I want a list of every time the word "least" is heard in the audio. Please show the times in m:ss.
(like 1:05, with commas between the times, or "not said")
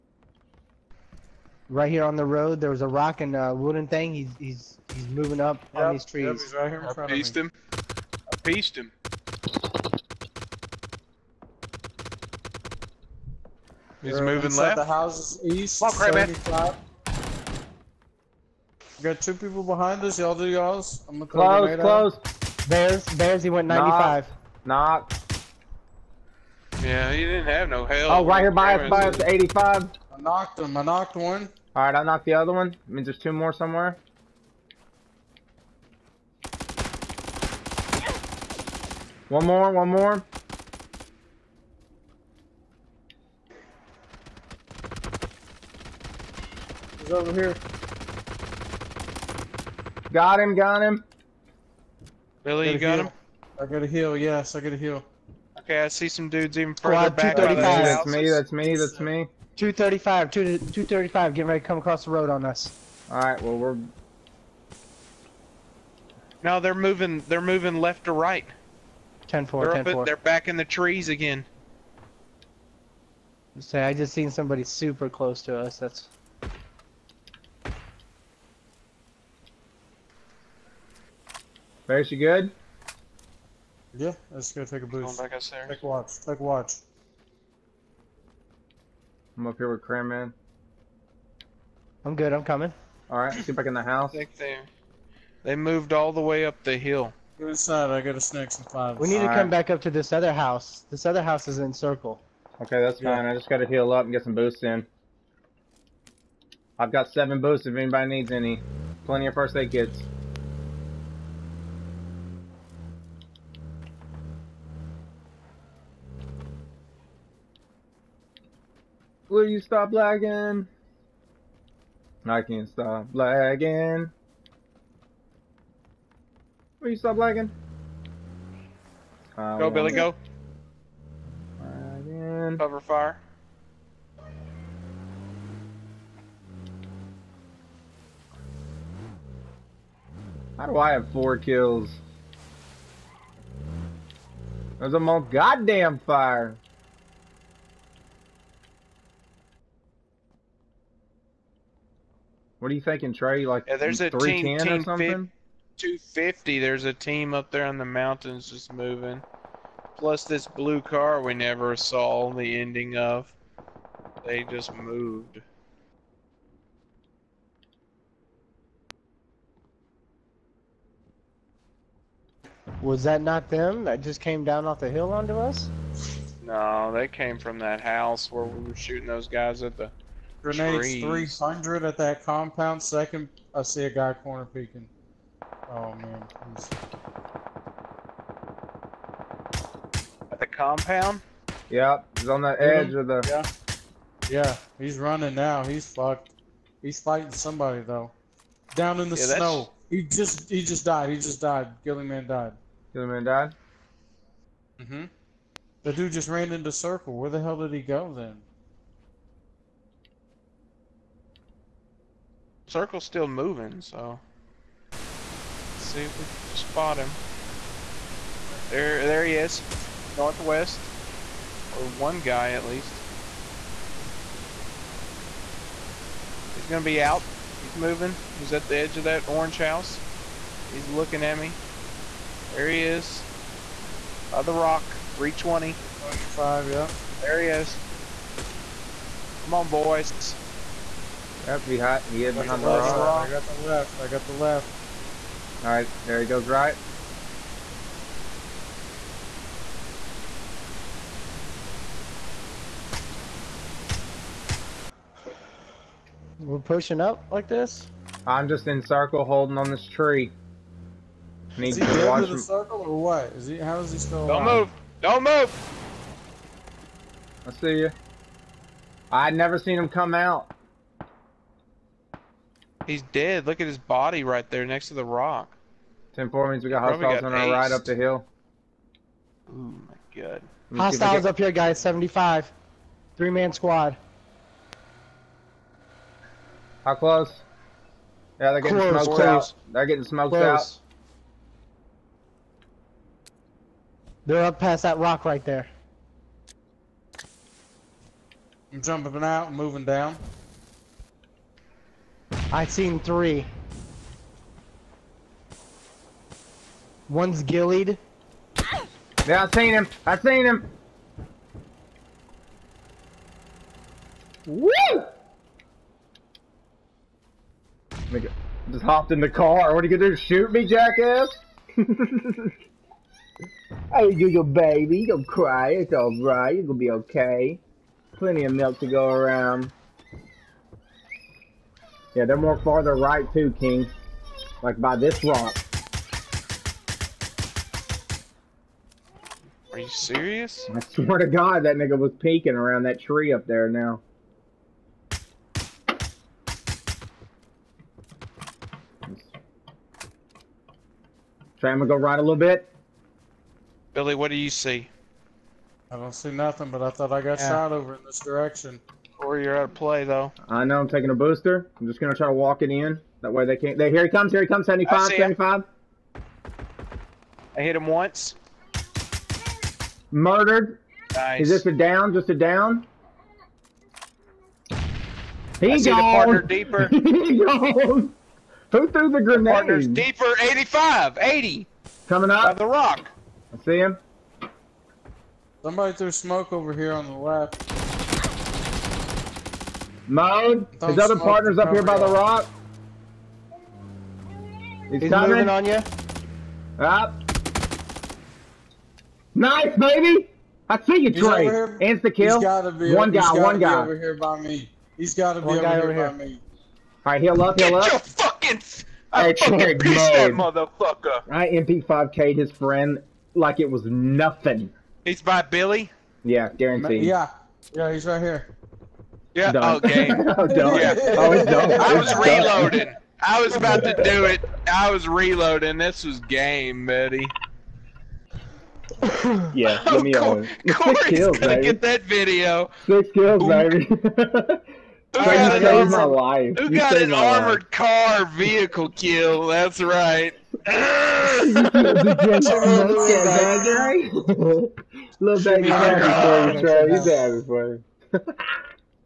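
3:42.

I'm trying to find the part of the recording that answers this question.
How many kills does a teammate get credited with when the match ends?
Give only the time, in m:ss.
7:12.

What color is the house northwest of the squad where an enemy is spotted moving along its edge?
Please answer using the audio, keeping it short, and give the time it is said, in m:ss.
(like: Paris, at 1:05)
Orange, at 3:49.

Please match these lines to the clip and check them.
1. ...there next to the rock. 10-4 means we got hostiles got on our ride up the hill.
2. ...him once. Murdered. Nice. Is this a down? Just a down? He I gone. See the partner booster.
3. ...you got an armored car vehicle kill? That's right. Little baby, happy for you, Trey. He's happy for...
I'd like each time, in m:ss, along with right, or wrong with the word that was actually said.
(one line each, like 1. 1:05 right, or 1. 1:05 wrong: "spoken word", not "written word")
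1. 4:34 right
2. 6:07 wrong: "deeper", not "booster"
3. 7:16 right.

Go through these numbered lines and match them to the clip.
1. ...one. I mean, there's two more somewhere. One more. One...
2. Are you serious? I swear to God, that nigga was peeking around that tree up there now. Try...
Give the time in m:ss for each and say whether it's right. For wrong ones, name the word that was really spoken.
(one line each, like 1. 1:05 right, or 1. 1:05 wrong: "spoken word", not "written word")
1. 0:32 right
2. 5:39 right.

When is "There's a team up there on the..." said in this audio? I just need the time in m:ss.
2:36.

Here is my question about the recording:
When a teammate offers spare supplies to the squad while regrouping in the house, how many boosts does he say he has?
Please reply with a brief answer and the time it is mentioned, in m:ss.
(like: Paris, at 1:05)
7, at 1:47.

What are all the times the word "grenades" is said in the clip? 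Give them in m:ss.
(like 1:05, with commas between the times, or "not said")
3:00, 6:19.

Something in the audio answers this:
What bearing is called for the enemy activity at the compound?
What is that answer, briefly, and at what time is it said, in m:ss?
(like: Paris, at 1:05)
300, at 3:01.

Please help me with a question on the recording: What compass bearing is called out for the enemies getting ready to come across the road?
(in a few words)
235.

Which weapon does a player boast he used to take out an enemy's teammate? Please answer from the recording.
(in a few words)
MP5K.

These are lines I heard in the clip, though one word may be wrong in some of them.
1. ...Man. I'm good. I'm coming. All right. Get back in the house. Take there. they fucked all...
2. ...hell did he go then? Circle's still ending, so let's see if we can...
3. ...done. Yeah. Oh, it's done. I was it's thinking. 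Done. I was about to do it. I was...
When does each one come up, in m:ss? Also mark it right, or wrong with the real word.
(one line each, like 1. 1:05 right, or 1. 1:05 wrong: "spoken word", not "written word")
1. 1:30 wrong: "moved", not "fucked"
2. 3:27 wrong: "moving", not "ending"
3. 7:00 wrong: "reloading", not "thinking".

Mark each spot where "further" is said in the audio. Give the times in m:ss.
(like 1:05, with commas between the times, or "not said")
0:56.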